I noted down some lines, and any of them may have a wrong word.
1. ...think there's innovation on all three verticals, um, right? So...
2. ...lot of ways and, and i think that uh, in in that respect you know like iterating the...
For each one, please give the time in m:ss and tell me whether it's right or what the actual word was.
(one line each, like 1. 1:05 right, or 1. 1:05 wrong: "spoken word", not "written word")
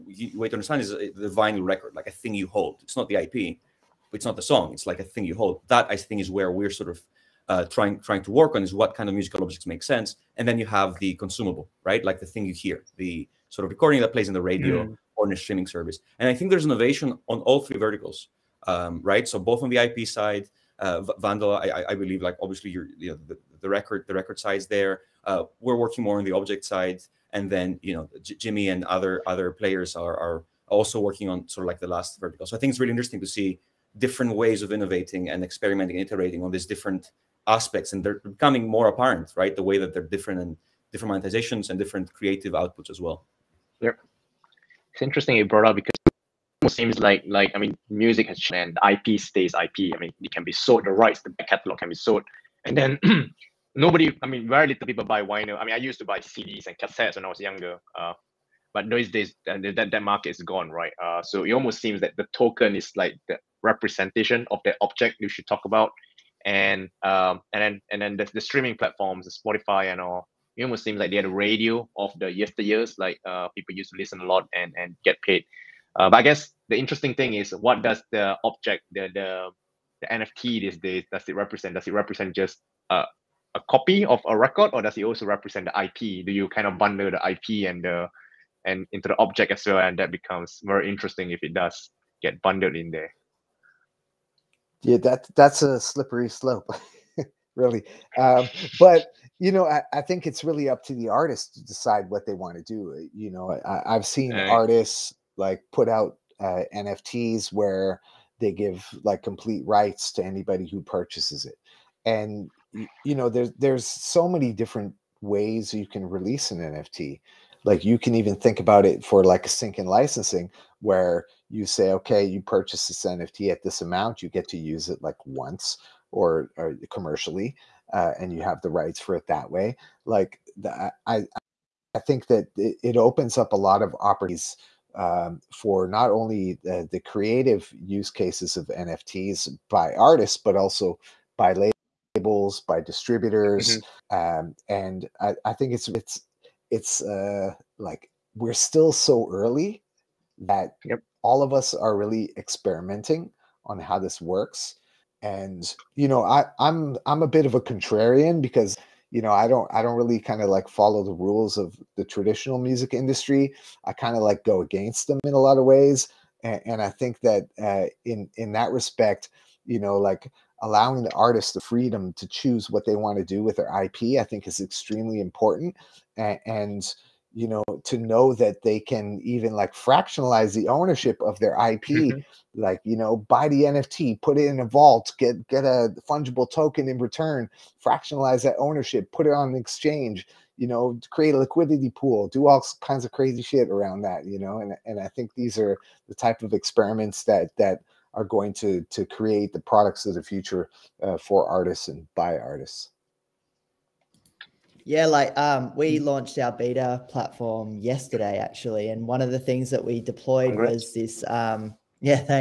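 1. 0:16 right
2. 2:45 wrong: "allowing", not "iterating".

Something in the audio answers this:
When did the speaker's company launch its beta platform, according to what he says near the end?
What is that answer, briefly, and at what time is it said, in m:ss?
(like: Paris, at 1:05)
Yesterday, at 3:27.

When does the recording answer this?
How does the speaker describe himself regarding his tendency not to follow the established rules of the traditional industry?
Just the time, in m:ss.
2:37.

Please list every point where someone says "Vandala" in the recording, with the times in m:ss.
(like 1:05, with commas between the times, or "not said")
0:21.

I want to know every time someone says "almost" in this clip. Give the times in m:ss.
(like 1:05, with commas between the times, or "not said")
1:01, 1:10.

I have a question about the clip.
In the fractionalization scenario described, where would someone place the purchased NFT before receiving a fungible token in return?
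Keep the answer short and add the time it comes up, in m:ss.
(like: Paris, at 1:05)
In a vault, at 3:04.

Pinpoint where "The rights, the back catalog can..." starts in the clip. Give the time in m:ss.
0:50.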